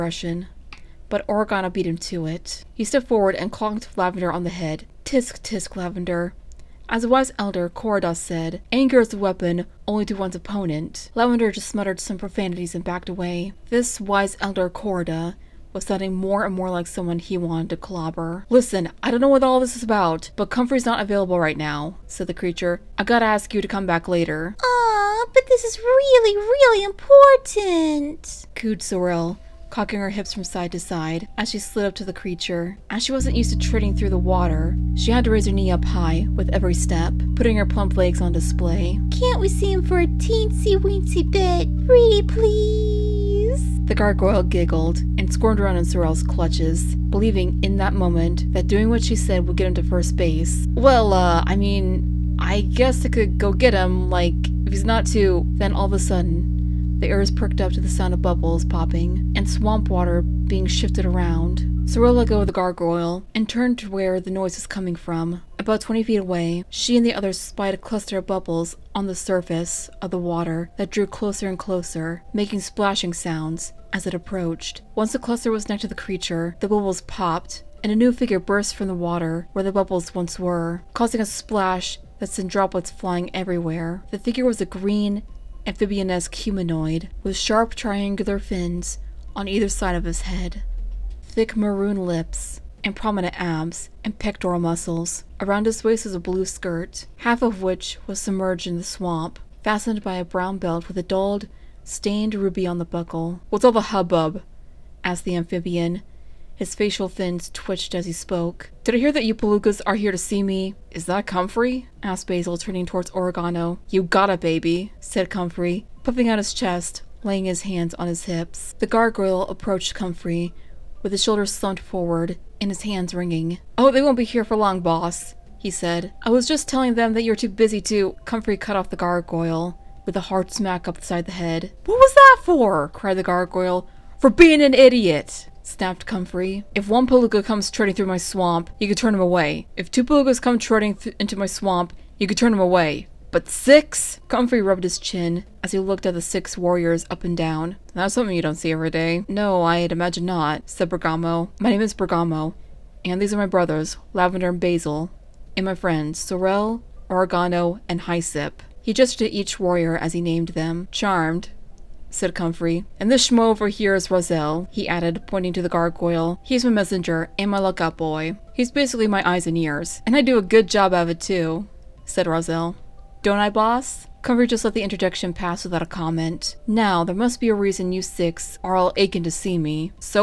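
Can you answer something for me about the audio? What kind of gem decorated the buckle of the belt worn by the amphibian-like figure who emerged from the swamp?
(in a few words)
ruby.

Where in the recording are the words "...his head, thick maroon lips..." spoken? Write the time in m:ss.
1:30.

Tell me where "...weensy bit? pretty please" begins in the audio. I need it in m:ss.
0:40.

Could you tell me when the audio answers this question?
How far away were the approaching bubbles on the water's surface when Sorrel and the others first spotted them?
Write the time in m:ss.
1:05.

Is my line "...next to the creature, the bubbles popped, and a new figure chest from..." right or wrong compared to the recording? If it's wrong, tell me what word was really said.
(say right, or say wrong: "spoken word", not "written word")
wrong: "burst", not "chest".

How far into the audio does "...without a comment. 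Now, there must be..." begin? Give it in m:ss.
2:55.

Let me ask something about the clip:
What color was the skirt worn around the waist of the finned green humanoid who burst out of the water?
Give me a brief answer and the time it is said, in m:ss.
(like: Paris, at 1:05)
blue, at 1:36.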